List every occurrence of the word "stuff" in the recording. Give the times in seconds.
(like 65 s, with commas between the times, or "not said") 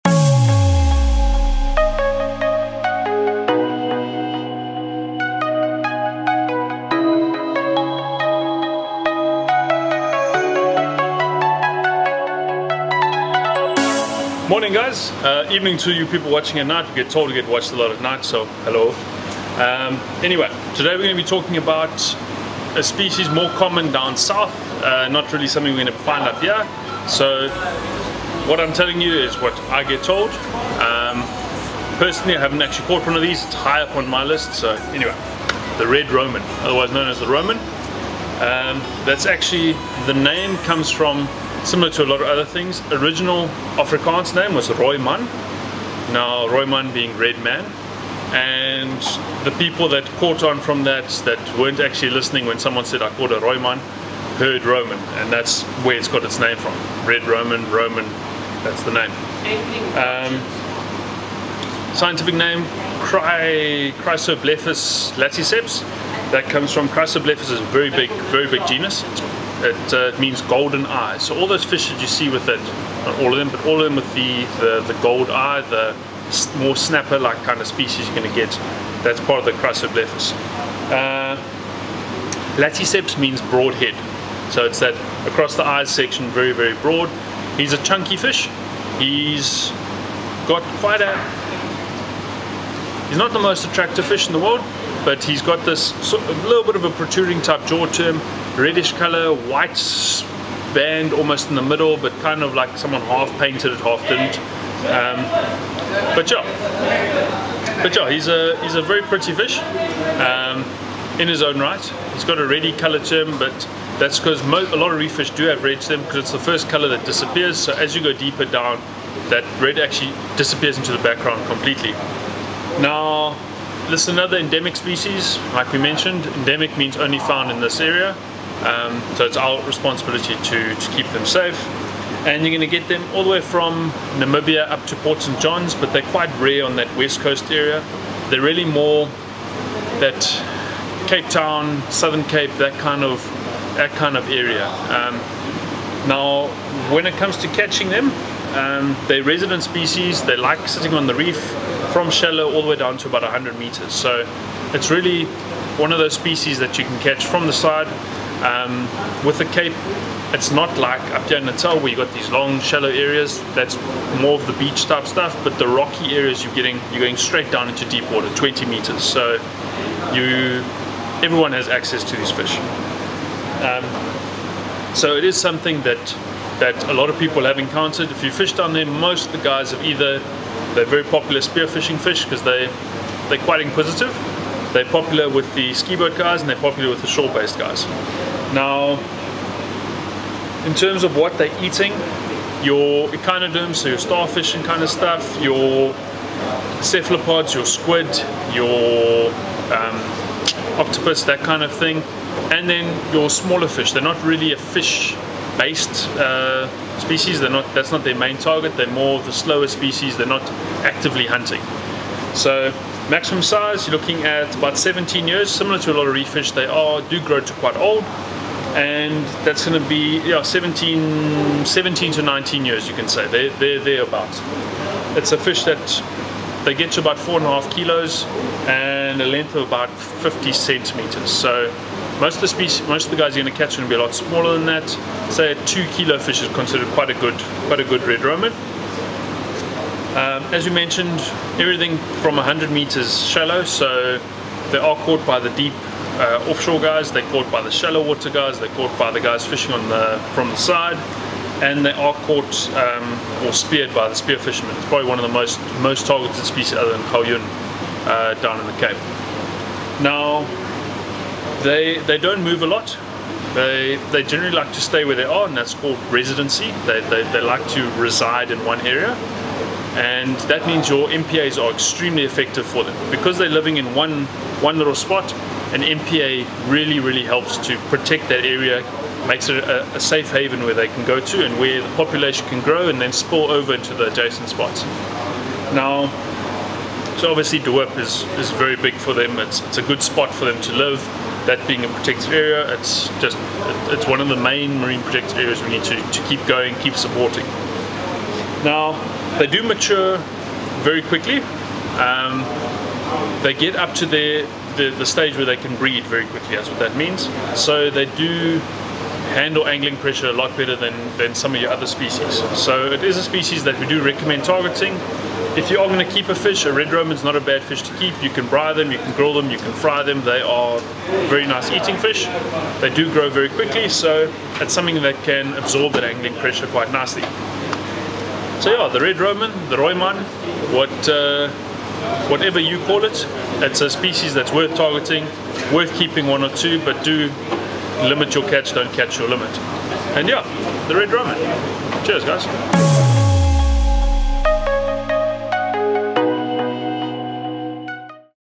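165 s, 194 s.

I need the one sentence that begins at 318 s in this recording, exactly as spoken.
You can braai them, you can grill them, you can fry them.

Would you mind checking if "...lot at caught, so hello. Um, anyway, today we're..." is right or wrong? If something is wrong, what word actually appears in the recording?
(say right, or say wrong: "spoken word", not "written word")
wrong: "night", not "caught".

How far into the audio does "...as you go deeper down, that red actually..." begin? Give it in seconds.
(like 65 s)
117 s.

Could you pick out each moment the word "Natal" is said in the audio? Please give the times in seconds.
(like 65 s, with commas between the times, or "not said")
161 s.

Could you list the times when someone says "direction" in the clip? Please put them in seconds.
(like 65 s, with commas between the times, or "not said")
not said.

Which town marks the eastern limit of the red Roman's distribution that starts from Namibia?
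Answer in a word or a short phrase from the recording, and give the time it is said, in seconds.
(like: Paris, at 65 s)
Port St. John's, at 134 s.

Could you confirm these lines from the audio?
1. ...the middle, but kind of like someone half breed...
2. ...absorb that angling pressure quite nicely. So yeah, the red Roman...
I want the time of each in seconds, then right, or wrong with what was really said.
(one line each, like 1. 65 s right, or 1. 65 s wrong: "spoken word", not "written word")
1. 101 s wrong: "painted", not "breed"
2. 325 s right.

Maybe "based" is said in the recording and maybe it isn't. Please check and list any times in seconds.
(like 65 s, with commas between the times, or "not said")
187 s, 204 s.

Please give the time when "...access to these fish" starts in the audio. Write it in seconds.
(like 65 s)
171 s.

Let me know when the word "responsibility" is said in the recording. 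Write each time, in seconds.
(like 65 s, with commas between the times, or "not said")
129 s.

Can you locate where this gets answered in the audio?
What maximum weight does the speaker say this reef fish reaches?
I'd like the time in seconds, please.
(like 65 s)
227 s.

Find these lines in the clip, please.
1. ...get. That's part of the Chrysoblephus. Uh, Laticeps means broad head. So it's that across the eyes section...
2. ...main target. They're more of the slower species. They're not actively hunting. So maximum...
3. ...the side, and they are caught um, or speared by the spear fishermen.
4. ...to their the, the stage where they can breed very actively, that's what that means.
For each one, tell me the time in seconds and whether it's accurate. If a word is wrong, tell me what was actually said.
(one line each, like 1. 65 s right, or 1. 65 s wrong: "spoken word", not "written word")
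1. 78 s right
2. 208 s right
3. 250 s right
4. 303 s wrong: "quickly", not "actively".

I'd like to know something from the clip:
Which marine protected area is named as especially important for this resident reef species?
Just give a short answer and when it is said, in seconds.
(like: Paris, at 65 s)
De Hoop, at 287 s.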